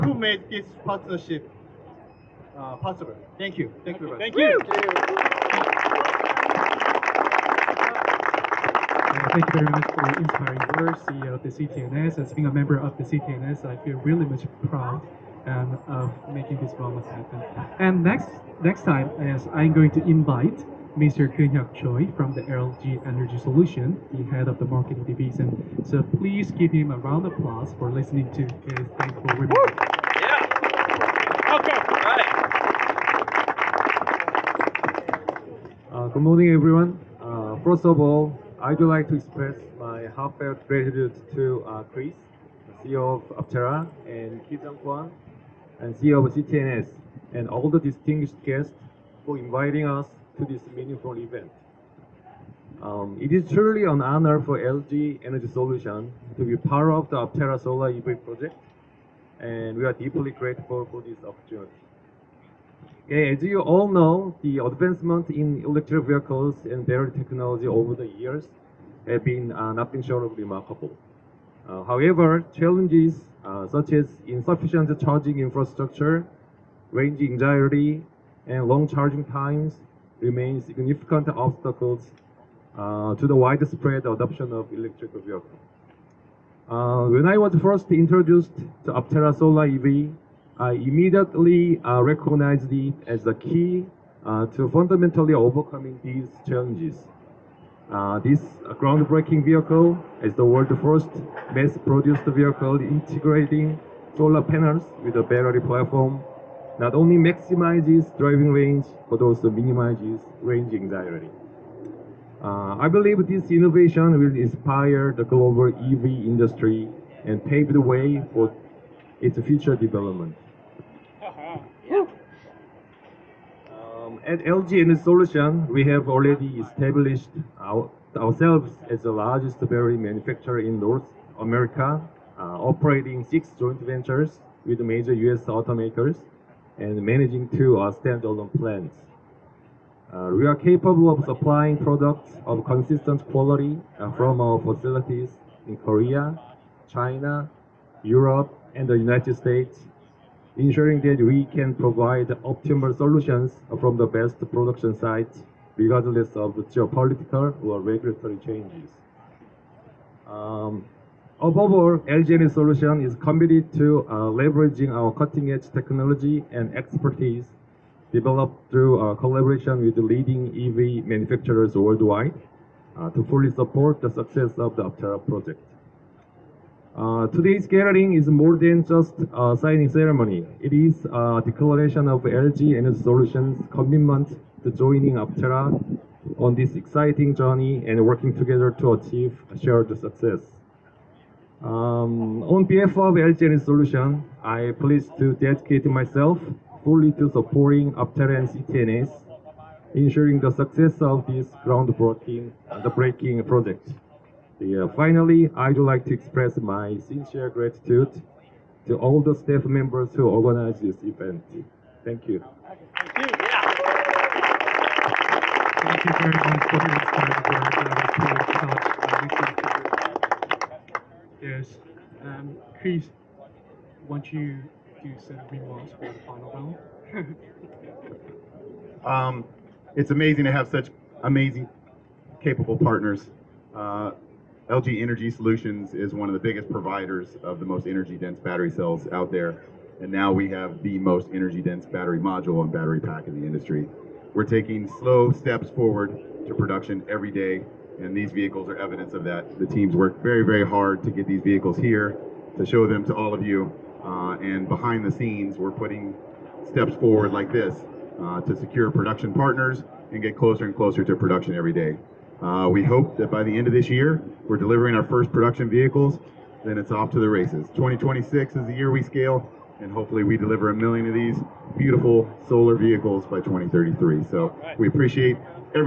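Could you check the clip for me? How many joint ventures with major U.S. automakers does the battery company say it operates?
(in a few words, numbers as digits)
6.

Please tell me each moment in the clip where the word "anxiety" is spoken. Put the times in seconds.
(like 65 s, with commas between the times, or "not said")
77 s, 110 s.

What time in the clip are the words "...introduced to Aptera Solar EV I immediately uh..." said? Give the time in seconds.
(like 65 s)
87 s.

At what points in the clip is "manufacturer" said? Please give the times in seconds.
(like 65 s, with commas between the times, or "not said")
129 s, 171 s.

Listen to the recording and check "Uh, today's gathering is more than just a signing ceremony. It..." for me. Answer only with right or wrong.
right.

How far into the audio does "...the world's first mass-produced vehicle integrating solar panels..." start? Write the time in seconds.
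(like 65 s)
100 s.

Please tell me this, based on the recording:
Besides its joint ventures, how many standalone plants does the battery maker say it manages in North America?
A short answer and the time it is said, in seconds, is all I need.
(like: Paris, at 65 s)
2, at 137 s.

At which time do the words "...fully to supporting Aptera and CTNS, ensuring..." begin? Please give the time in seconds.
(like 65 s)
196 s.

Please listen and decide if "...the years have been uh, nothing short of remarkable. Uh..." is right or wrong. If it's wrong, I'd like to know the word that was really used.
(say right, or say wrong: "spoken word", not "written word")
right.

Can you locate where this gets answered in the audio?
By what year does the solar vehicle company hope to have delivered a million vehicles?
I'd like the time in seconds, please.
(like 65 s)
273 s.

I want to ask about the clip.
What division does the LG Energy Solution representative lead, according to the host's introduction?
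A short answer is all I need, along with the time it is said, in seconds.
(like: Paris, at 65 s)
Marketing division, at 24 s.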